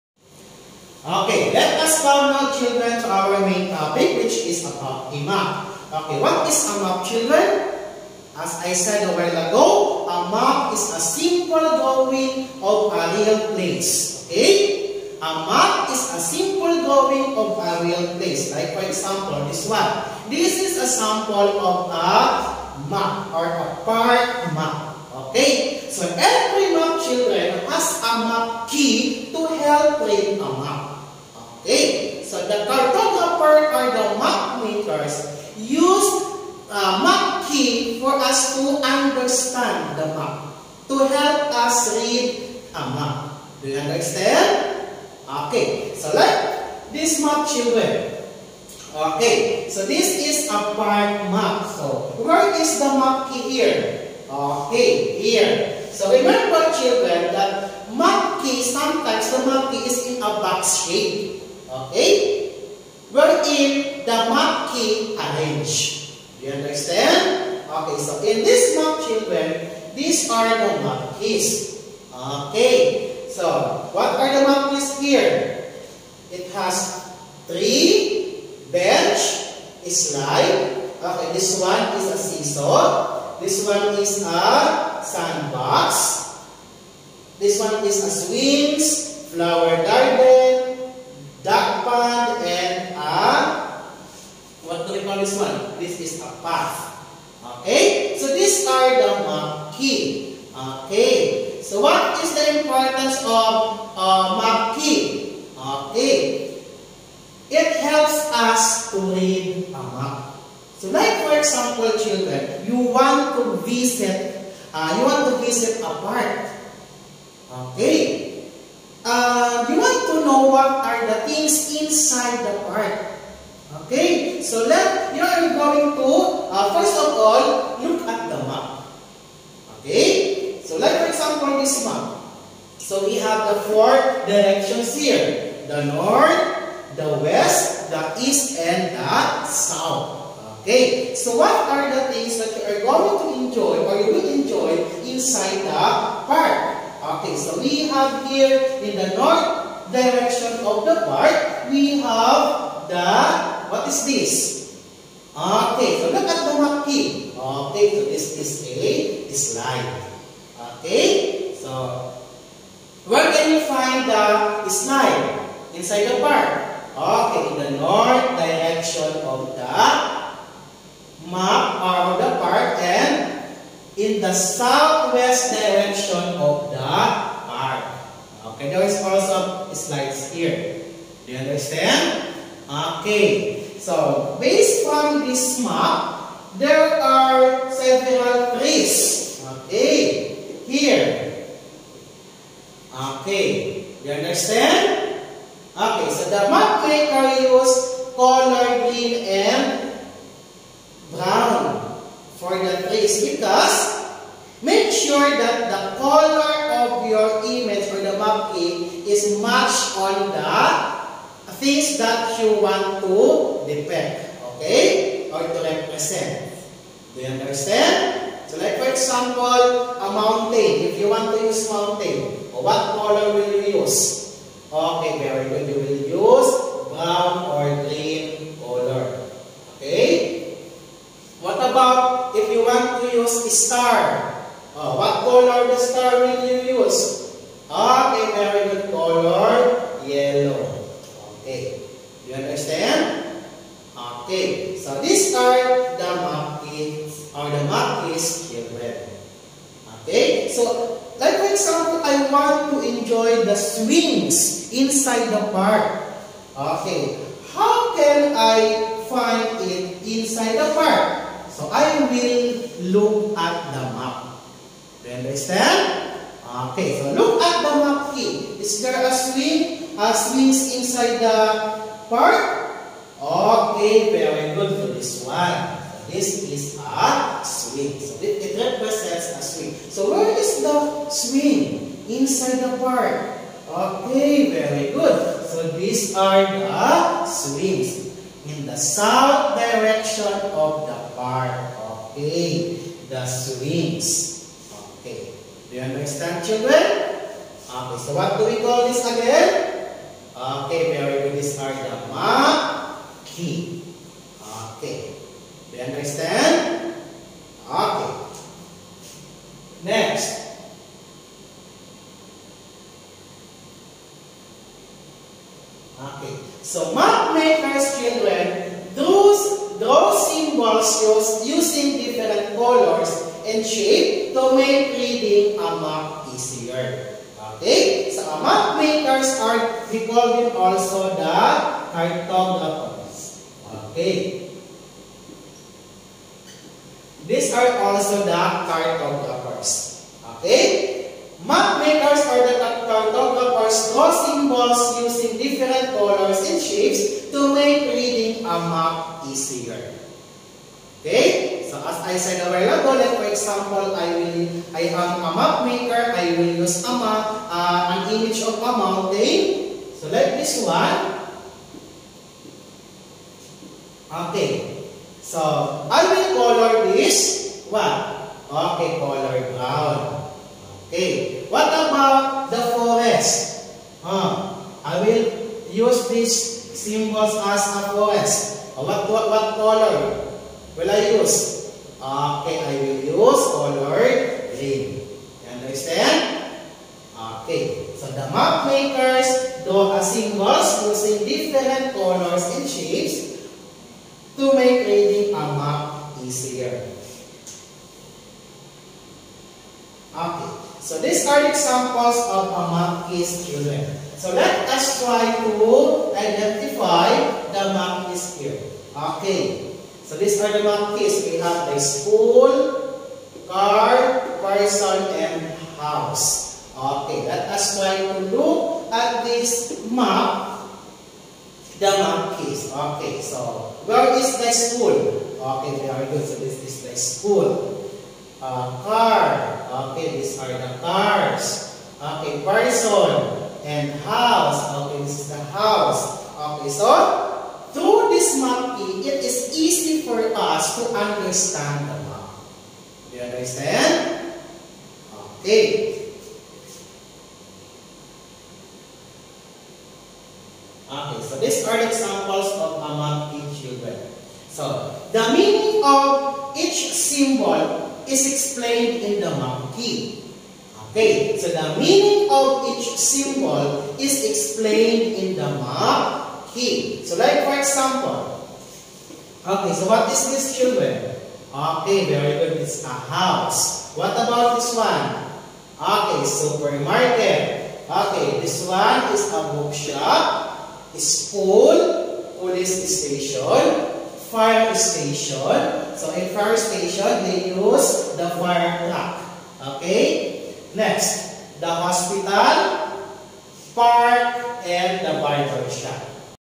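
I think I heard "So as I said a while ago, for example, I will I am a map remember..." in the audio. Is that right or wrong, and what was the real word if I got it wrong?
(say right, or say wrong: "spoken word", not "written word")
wrong: "maker", not "remember".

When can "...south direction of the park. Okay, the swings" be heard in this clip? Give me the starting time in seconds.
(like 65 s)
288 s.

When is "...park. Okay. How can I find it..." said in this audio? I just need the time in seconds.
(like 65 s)
255 s.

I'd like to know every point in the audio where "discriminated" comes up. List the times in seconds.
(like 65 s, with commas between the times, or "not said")
not said.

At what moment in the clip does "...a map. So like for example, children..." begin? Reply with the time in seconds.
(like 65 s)
109 s.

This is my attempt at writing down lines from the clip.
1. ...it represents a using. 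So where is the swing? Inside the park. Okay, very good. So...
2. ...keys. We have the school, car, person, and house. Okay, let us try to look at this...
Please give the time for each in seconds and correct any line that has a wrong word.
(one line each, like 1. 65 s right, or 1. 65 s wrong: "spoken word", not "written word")
1. 278 s wrong: "swing", not "using"
2. 410 s right.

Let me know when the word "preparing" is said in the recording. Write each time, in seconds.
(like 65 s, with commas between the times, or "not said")
not said.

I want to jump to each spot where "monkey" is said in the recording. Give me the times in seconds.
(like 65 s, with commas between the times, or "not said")
64 s.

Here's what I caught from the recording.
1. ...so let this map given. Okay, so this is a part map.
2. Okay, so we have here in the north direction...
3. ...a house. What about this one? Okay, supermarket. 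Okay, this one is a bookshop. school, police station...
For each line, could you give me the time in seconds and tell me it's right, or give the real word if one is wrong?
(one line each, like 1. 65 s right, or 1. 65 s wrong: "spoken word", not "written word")
1. 45 s wrong: "children", not "given"
2. 147 s right
3. 472 s right.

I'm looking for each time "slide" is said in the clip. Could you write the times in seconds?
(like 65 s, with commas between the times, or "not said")
79 s, 159 s, 164 s, 179 s.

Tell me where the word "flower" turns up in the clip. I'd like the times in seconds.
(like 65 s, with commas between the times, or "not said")
89 s.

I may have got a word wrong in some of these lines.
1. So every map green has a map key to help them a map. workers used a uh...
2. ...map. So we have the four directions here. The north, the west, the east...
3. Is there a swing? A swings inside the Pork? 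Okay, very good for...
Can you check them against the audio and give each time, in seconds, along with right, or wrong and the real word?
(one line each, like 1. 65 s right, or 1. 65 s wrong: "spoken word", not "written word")
1. 25 s wrong: "children", not "green"
2. 131 s right
3. 268 s right.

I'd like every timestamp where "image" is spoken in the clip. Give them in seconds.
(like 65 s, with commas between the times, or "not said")
207 s, 358 s.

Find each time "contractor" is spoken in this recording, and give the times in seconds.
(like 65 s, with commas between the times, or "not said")
not said.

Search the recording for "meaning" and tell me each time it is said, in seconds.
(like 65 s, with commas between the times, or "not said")
455 s, 461 s.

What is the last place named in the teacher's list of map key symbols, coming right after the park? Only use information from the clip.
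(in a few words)
barber shop.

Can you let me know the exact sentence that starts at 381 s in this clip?
Okay, I will use color green.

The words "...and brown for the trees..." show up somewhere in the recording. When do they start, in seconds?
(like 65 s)
199 s.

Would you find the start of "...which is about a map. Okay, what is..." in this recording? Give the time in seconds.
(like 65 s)
4 s.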